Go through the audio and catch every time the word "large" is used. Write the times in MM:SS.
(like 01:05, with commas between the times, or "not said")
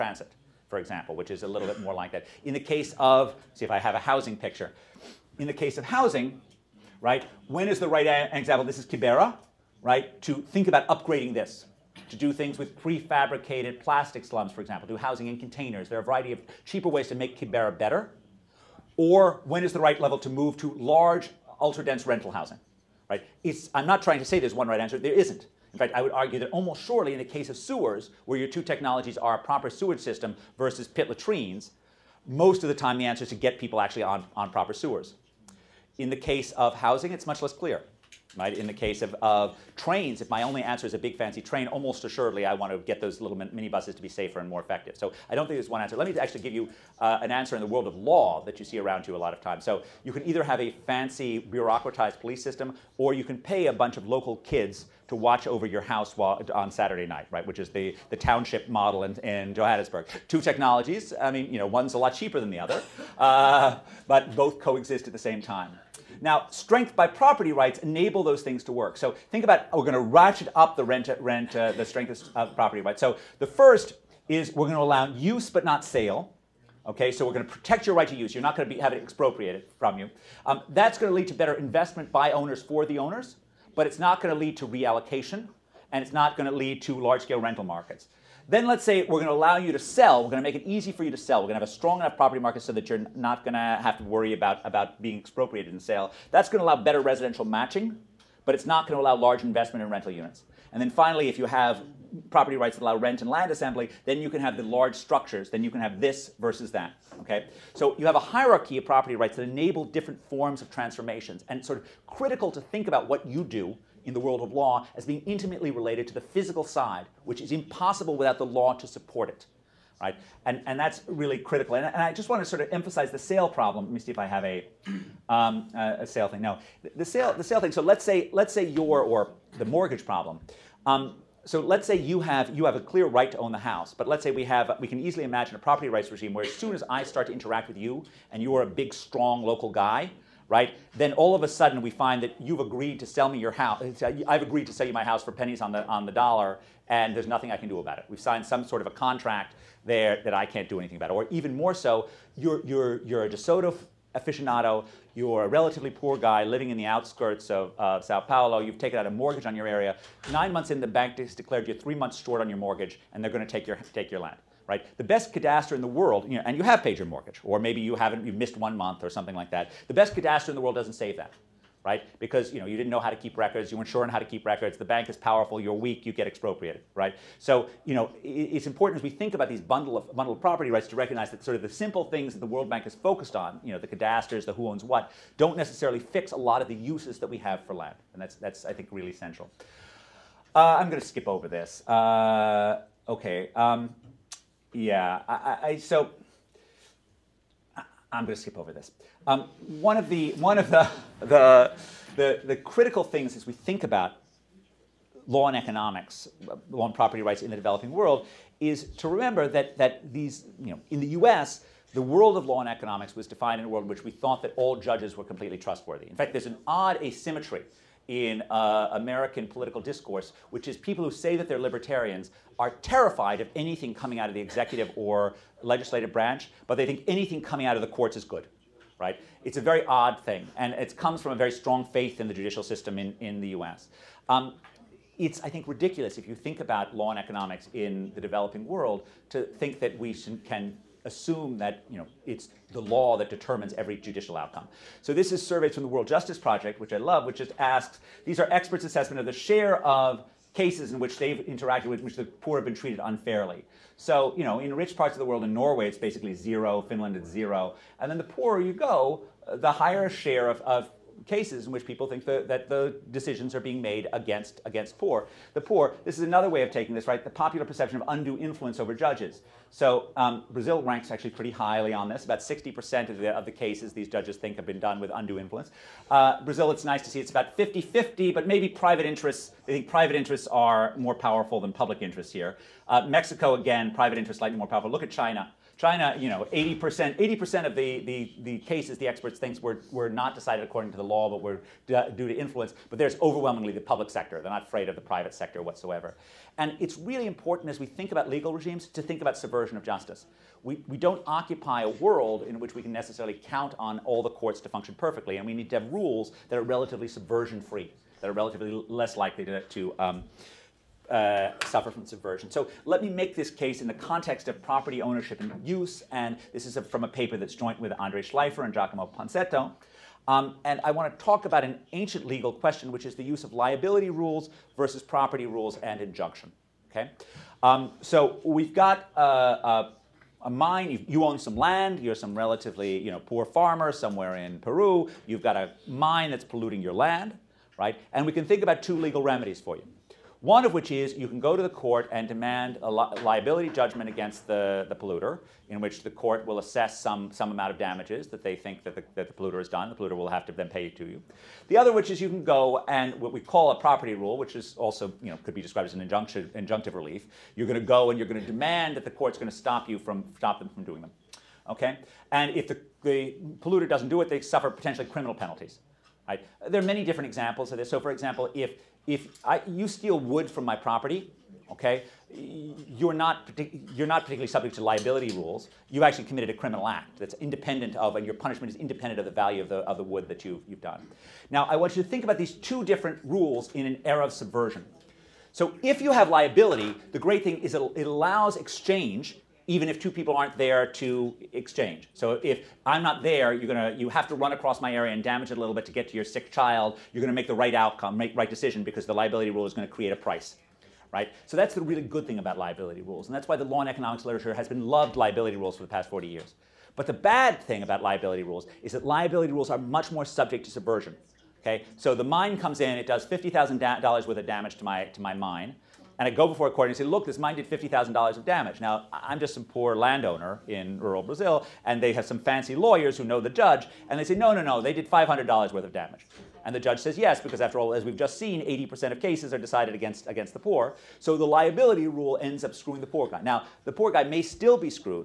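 00:20, 01:26, 01:39, 01:44.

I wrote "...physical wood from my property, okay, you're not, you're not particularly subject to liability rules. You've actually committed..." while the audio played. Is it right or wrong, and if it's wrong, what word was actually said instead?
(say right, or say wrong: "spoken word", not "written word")
wrong: "steal", not "physical".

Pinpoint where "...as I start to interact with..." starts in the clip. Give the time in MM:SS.
02:16.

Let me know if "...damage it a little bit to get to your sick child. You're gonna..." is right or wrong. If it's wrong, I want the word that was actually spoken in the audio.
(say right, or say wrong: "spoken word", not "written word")
right.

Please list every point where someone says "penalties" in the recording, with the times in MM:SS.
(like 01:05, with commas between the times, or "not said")
06:05.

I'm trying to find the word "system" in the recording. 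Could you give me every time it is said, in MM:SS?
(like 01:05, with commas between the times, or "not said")
00:29, 00:52, 03:52.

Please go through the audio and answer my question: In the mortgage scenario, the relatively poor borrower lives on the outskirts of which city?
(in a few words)
Sao Paulo.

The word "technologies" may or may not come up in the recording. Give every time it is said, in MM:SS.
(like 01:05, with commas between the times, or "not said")
00:28, 01:00.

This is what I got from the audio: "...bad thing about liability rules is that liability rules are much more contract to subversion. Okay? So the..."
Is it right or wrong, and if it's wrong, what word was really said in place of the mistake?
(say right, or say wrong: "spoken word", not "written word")
wrong: "subject", not "contract".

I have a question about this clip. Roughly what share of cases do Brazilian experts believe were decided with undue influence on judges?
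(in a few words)
60%.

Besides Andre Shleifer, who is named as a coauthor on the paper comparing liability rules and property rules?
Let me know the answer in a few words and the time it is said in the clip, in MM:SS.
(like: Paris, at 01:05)
Giacomo Ponzetto, at 05:18.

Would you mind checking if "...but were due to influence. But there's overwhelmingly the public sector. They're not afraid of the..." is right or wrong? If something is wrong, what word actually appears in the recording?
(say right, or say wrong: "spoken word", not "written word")
right.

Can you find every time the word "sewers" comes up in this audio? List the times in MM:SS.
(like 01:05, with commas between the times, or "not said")
00:27, 00:34.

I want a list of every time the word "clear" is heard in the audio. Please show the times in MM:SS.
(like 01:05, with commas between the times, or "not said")
00:37, 02:12.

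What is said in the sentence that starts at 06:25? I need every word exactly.
So if you have liability, the great thing is it, it allows exchange even if two people aren't there to exchange.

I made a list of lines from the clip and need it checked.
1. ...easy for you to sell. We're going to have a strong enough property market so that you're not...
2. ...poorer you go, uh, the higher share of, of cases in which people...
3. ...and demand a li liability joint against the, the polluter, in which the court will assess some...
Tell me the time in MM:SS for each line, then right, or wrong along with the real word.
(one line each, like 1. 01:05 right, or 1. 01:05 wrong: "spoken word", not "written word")
1. 01:30 right
2. 04:18 right
3. 05:42 wrong: "judgment", not "joint".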